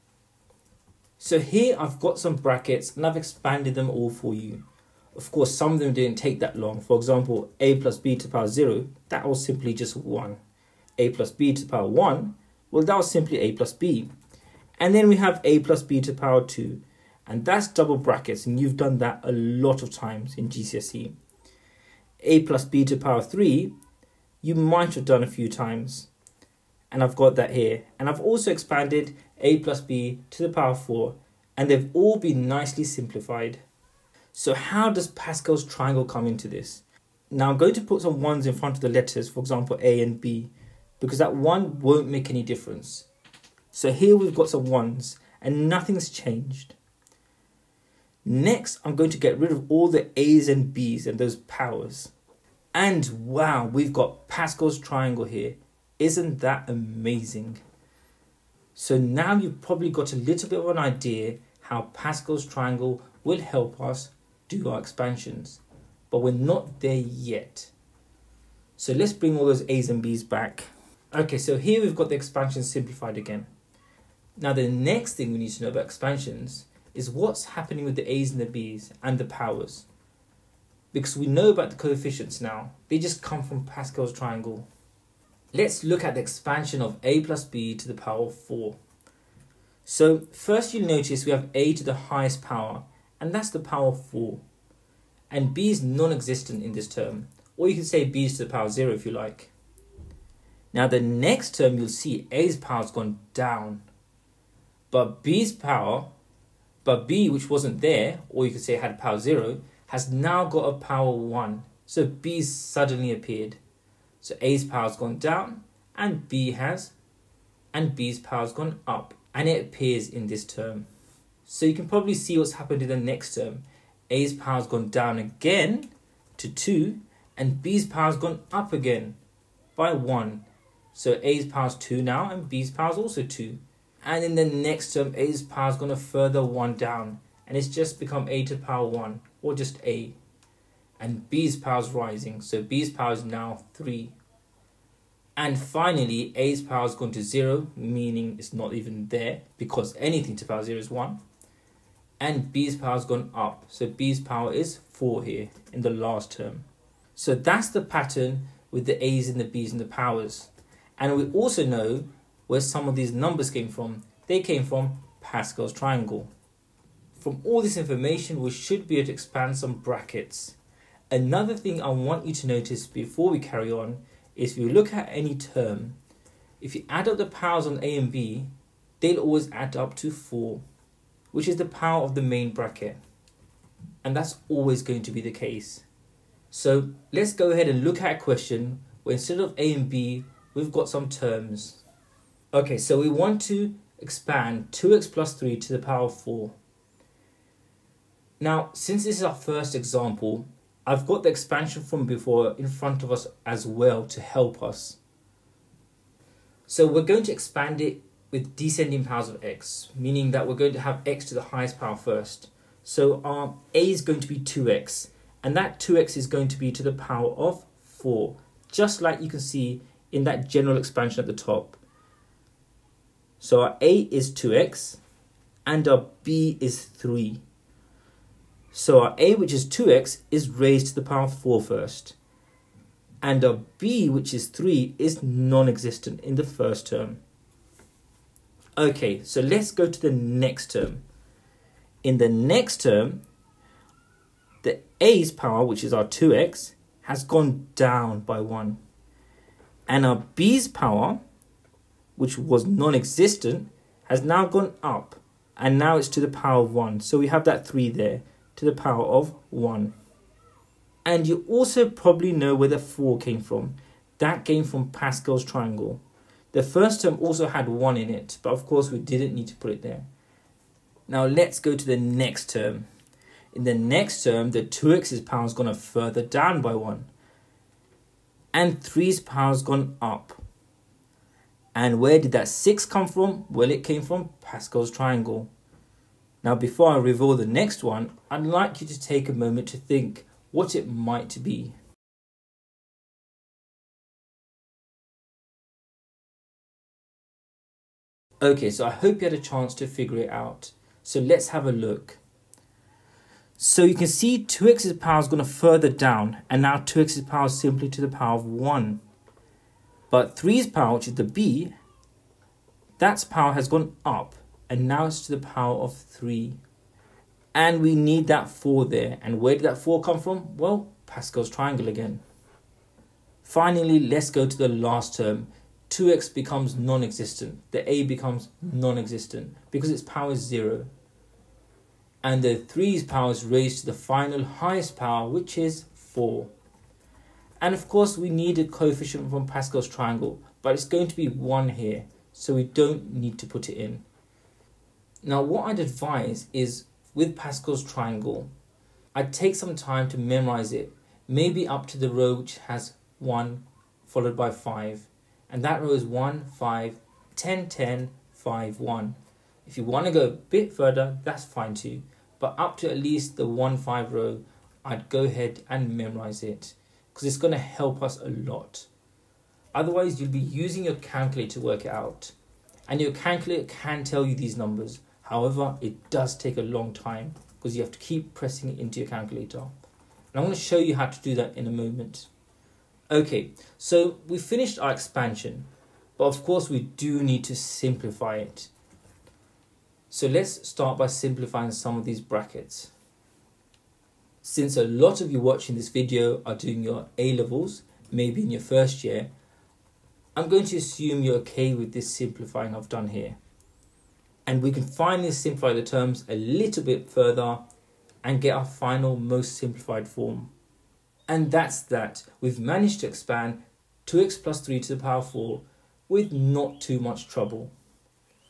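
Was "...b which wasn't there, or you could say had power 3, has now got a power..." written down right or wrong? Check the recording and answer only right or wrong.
wrong.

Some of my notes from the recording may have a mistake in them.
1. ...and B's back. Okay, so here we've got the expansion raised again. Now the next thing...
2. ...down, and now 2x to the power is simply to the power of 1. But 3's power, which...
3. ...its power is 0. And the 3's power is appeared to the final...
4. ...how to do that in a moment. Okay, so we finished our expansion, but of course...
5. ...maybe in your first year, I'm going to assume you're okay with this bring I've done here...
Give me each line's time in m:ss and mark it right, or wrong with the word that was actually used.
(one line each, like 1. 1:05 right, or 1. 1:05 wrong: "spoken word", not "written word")
1. 1:09 wrong: "simplified", not "raised"
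2. 5:05 right
3. 5:29 wrong: "raised", not "appeared"
4. 6:20 right
5. 6:38 wrong: "simplifying", not "bring".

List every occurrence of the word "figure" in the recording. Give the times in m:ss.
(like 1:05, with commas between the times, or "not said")
4:59.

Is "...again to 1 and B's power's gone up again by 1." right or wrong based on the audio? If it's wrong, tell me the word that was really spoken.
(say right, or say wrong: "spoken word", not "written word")
wrong: "2", not "1".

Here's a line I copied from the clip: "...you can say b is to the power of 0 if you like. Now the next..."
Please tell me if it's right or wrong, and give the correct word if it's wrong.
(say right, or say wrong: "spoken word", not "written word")
right.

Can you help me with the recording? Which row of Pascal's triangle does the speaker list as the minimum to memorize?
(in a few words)
1, 5, 10, 10, 5, 1.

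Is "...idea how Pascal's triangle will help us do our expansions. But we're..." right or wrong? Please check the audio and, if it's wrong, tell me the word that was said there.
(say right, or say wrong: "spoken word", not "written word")
right.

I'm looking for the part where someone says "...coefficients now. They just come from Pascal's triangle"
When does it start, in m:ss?
1:21.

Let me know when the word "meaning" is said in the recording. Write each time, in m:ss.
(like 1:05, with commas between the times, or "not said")
2:27, 3:29.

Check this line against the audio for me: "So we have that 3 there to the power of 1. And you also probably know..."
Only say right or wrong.
right.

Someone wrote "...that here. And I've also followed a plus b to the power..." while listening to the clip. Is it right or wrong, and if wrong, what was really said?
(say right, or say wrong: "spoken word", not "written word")
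wrong: "expanded", not "followed".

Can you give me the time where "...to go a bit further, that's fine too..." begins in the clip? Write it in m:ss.
6:00.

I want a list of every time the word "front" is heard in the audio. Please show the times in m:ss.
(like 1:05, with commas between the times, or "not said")
0:38, 3:22.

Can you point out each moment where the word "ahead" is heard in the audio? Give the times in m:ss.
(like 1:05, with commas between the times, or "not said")
3:07, 6:05.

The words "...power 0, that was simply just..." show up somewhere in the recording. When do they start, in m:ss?
0:08.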